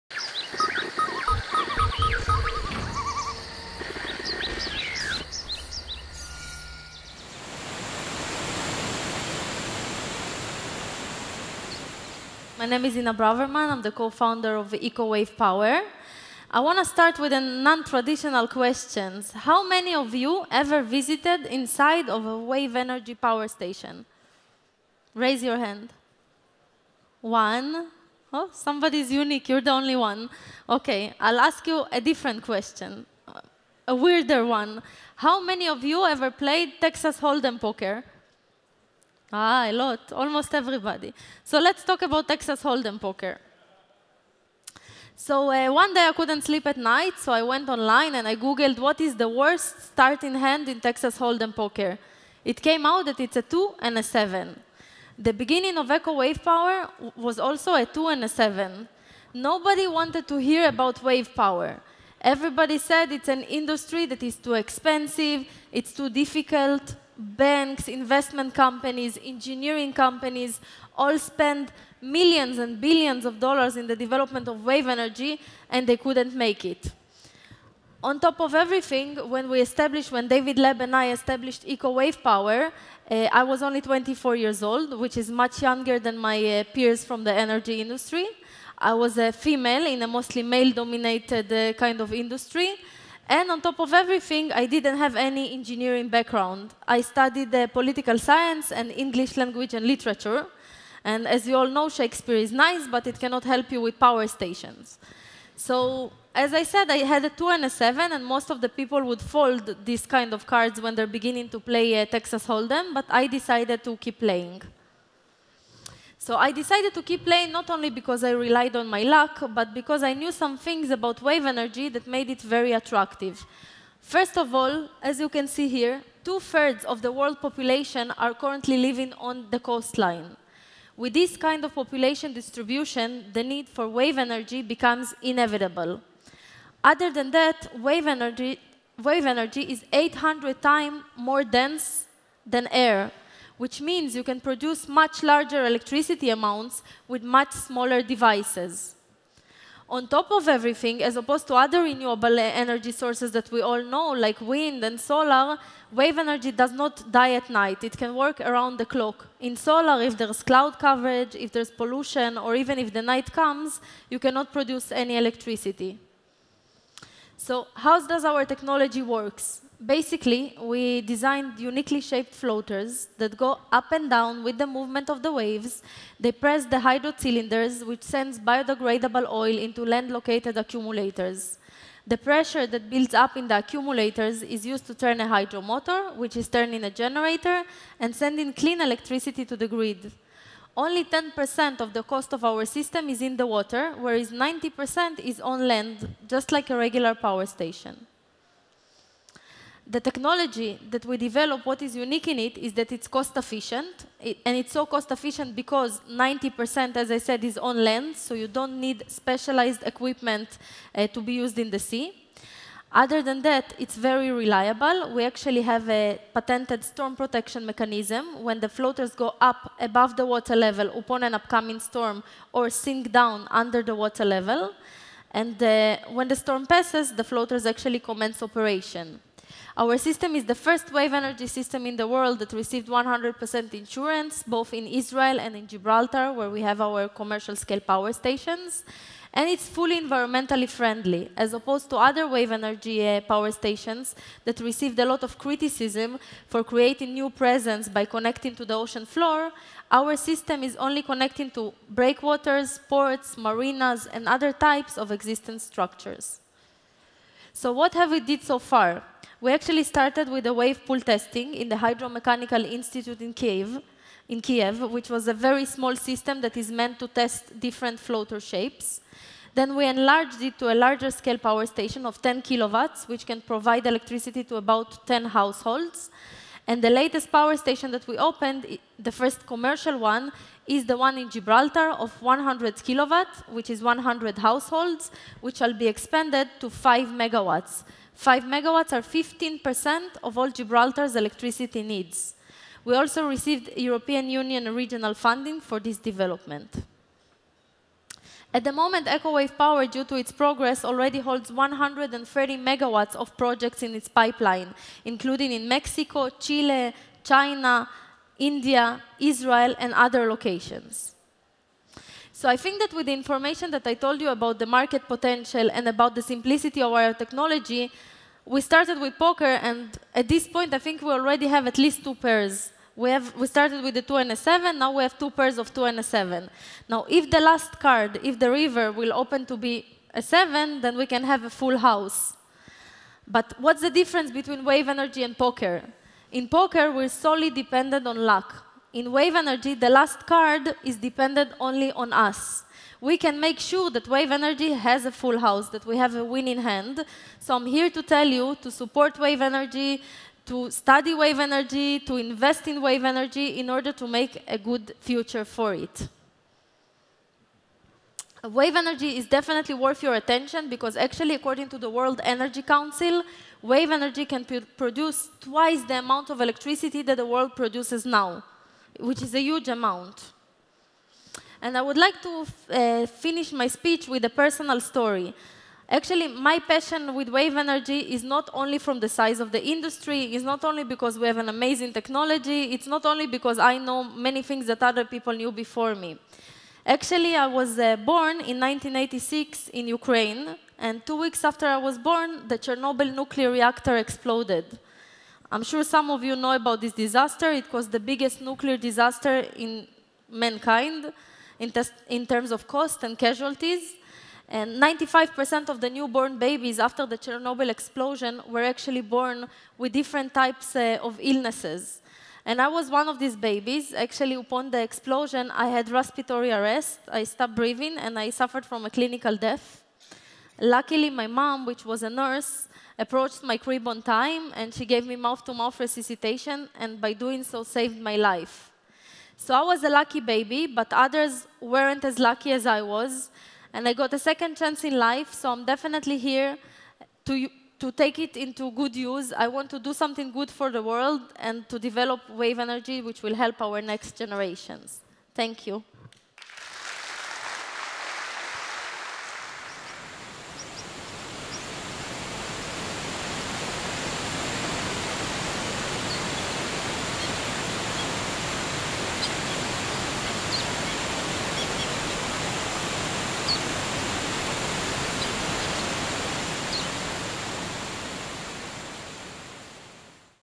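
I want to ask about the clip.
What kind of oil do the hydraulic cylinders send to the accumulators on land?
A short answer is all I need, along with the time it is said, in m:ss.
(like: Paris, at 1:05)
Biodegradable oil, at 2:58.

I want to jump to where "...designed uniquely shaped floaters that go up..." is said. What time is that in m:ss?
2:51.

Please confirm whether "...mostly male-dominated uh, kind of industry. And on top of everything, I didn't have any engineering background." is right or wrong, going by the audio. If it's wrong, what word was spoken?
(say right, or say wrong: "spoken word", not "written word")
right.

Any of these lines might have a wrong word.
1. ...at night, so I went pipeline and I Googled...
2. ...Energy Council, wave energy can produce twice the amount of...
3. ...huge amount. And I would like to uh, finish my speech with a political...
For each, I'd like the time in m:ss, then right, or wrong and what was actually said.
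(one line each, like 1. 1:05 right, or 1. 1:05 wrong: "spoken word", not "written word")
1. 0:46 wrong: "online", not "pipeline"
2. 6:02 right
3. 6:09 wrong: "personal", not "political".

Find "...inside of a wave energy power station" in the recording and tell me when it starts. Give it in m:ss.
0:21.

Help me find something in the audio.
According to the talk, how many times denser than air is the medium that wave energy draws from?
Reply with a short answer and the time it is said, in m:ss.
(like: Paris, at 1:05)
800, at 2:19.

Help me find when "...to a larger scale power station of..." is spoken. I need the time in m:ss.
4:30.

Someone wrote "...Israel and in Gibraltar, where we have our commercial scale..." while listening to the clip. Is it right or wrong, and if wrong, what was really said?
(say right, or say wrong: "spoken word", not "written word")
right.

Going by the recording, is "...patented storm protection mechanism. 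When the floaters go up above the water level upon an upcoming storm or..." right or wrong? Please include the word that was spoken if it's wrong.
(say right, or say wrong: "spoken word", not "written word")
right.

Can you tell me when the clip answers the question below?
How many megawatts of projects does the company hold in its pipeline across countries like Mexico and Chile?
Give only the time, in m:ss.
5:01.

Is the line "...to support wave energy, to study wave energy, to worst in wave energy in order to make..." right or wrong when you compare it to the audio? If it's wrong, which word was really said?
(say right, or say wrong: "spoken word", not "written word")
wrong: "invest", not "worst".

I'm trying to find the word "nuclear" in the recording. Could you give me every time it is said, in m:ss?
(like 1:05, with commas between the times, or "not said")
6:33, 6:38.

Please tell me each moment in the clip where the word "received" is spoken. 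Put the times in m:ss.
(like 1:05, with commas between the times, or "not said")
3:52, 4:04, 4:53.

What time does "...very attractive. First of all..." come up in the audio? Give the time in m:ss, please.
2:02.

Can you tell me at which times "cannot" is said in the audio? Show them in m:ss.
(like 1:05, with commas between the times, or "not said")
1:43, 2:44.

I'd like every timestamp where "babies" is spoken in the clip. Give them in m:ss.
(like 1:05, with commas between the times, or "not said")
6:46, 6:53.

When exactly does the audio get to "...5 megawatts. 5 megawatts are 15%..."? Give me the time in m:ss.
4:46.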